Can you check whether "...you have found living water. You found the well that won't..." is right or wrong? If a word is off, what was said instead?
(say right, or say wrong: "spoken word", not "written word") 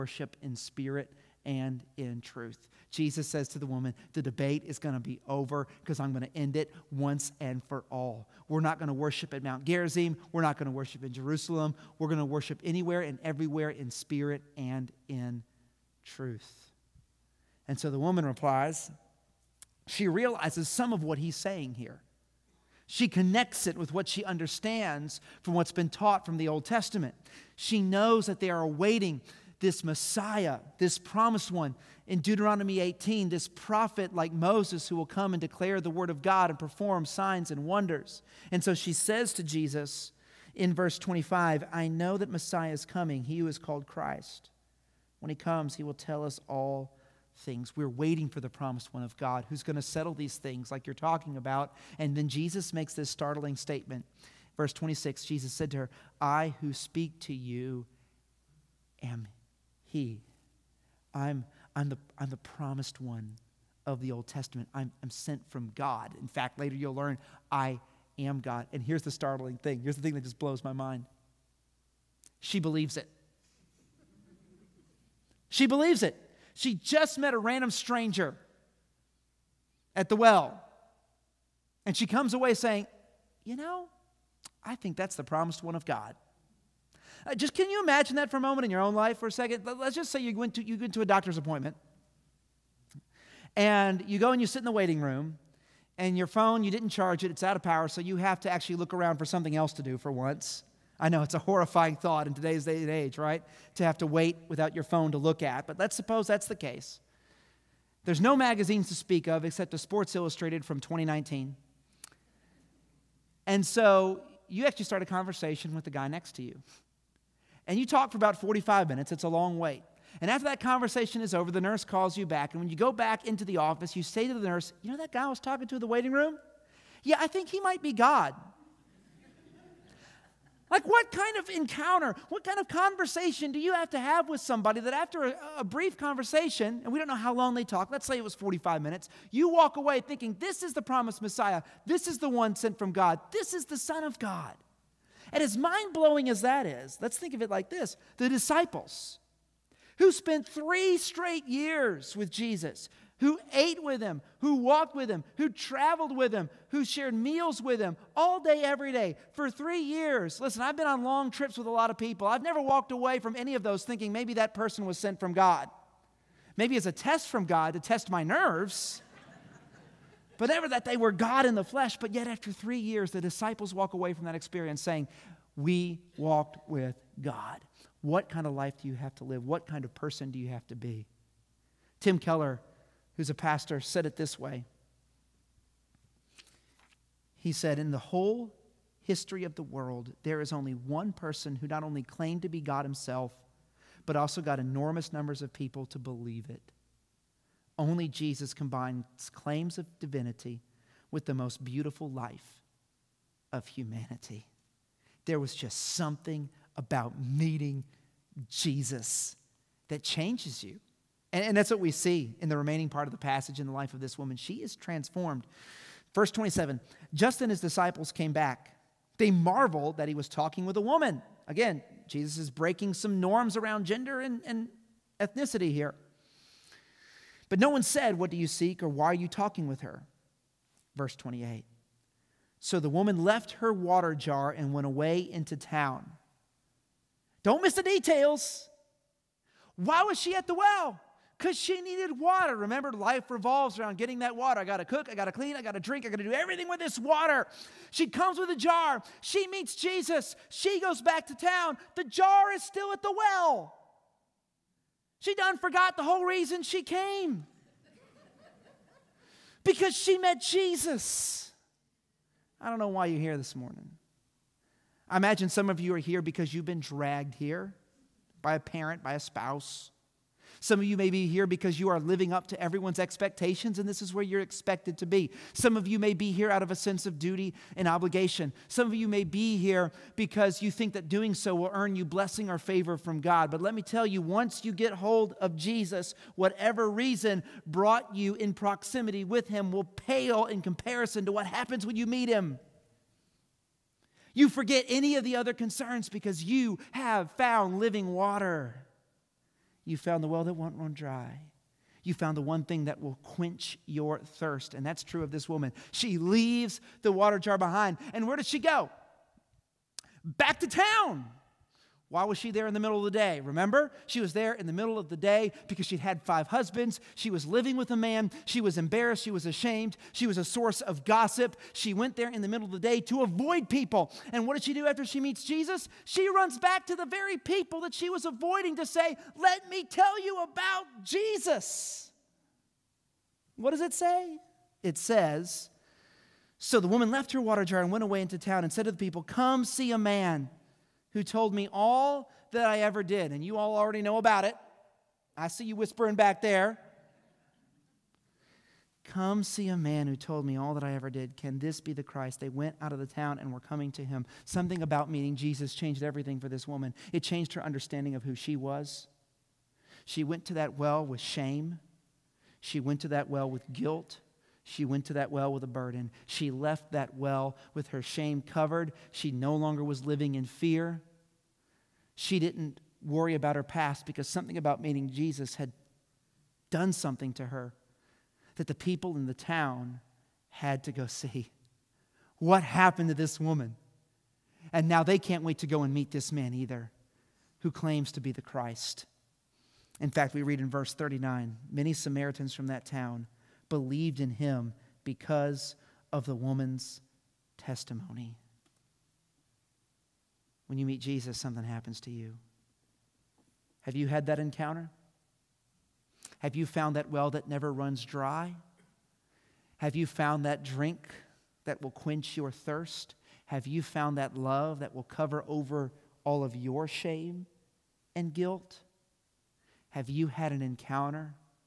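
right.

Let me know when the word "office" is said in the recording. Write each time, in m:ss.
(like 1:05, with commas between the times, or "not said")
2:03.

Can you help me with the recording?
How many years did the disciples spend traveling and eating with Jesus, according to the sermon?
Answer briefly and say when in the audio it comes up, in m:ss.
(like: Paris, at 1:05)
3, at 2:30.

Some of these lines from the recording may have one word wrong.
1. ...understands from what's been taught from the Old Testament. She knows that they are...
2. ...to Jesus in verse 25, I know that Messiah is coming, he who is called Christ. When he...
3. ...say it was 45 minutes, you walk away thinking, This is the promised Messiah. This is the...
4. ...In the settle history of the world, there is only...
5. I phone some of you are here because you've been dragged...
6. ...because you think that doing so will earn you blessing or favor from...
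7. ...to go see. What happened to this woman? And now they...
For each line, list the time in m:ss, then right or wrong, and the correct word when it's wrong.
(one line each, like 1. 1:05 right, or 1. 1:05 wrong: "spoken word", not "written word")
1. 0:24 right
2. 0:39 right
3. 2:18 right
4. 3:07 wrong: "whole", not "settle"
5. 4:25 wrong: "imagine", not "phone"
6. 4:40 right
7. 6:20 right.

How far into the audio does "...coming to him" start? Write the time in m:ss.
5:53.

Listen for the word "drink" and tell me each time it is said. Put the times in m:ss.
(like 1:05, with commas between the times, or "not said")
4:05, 6:50.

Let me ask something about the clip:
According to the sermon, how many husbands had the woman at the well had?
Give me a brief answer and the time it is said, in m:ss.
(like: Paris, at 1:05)
5, at 5:16.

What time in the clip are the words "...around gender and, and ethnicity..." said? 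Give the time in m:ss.
3:43.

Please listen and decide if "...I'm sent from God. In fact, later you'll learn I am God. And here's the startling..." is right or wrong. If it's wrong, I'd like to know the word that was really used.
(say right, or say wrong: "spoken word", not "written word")
right.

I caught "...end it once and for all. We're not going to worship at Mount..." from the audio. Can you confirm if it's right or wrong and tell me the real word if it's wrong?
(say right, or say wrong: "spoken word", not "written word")
right.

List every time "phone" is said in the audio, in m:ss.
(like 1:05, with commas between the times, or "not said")
1:36, 1:44.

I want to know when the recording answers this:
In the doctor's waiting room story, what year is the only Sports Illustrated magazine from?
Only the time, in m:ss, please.
1:50.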